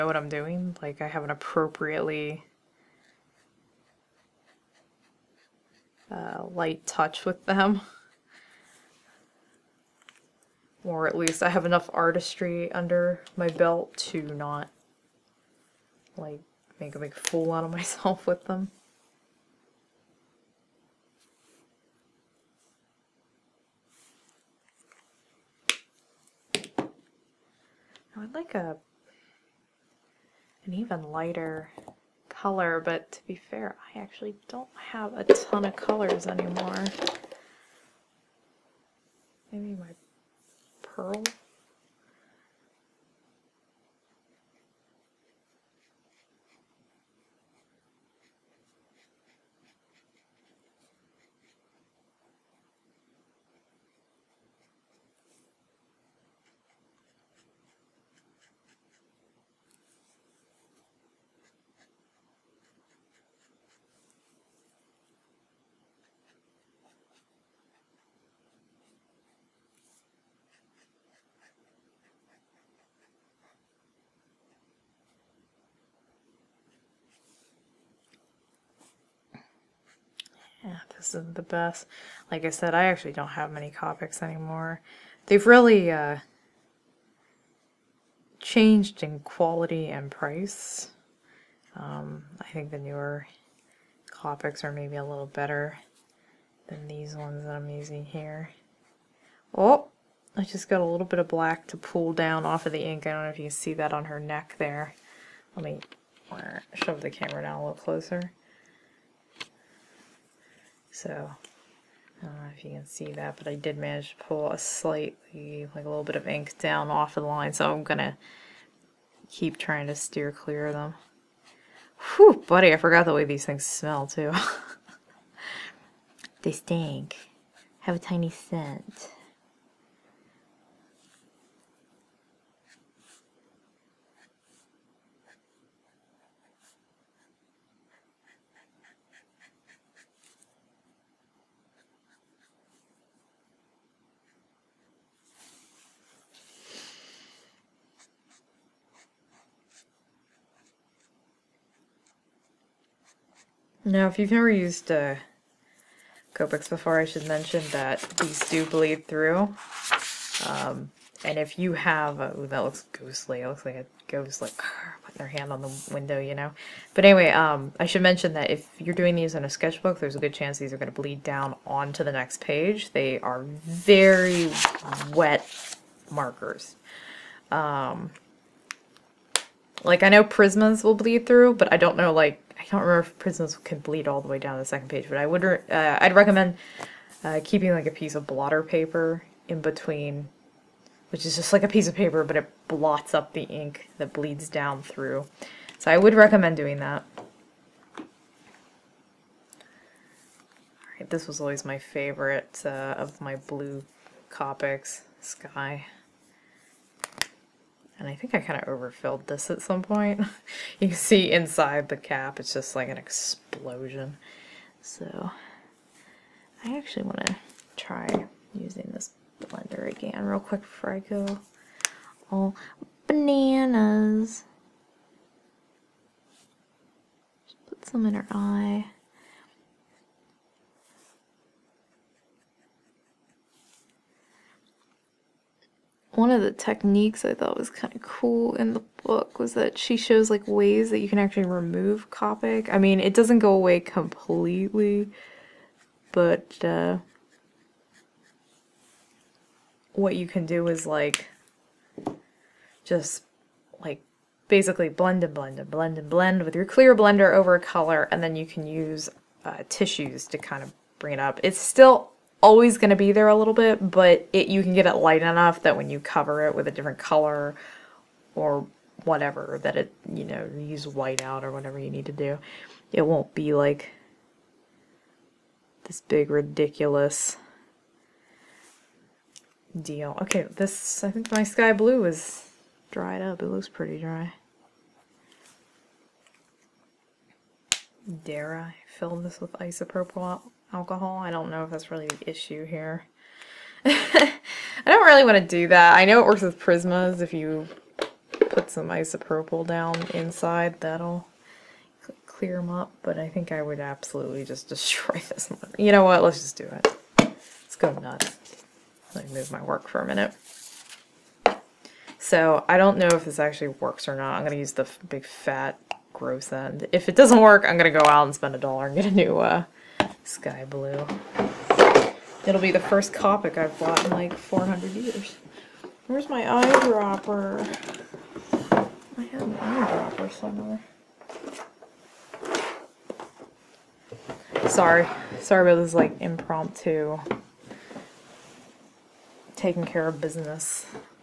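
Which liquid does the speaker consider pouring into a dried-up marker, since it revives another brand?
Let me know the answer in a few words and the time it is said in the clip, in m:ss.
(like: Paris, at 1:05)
isopropyl alcohol, at 4:49.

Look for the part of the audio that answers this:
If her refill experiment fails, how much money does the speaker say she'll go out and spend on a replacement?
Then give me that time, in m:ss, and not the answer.
5:18.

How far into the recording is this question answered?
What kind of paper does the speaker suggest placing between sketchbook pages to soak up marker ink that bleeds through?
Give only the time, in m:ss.
3:08.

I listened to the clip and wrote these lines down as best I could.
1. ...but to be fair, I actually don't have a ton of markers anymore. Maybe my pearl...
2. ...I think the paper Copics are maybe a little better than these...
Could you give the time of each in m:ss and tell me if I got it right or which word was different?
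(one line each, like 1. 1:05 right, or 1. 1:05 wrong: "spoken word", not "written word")
1. 0:32 wrong: "colors", not "markers"
2. 1:32 wrong: "newer", not "paper".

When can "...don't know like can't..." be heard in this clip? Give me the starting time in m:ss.
3:01.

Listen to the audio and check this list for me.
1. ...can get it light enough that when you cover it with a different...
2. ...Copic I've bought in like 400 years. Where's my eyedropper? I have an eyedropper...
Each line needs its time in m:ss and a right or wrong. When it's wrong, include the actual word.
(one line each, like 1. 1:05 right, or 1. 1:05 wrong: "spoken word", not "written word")
1. 4:24 right
2. 5:23 right.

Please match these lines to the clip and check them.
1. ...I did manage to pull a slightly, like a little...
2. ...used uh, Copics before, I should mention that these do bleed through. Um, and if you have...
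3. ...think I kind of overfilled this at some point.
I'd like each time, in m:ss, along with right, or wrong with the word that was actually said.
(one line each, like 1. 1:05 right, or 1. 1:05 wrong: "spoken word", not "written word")
1. 1:53 right
2. 2:34 right
3. 3:28 right.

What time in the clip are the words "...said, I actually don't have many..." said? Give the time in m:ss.
1:22.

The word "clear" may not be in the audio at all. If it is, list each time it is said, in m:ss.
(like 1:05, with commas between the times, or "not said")
2:00, 4:16, 5:02.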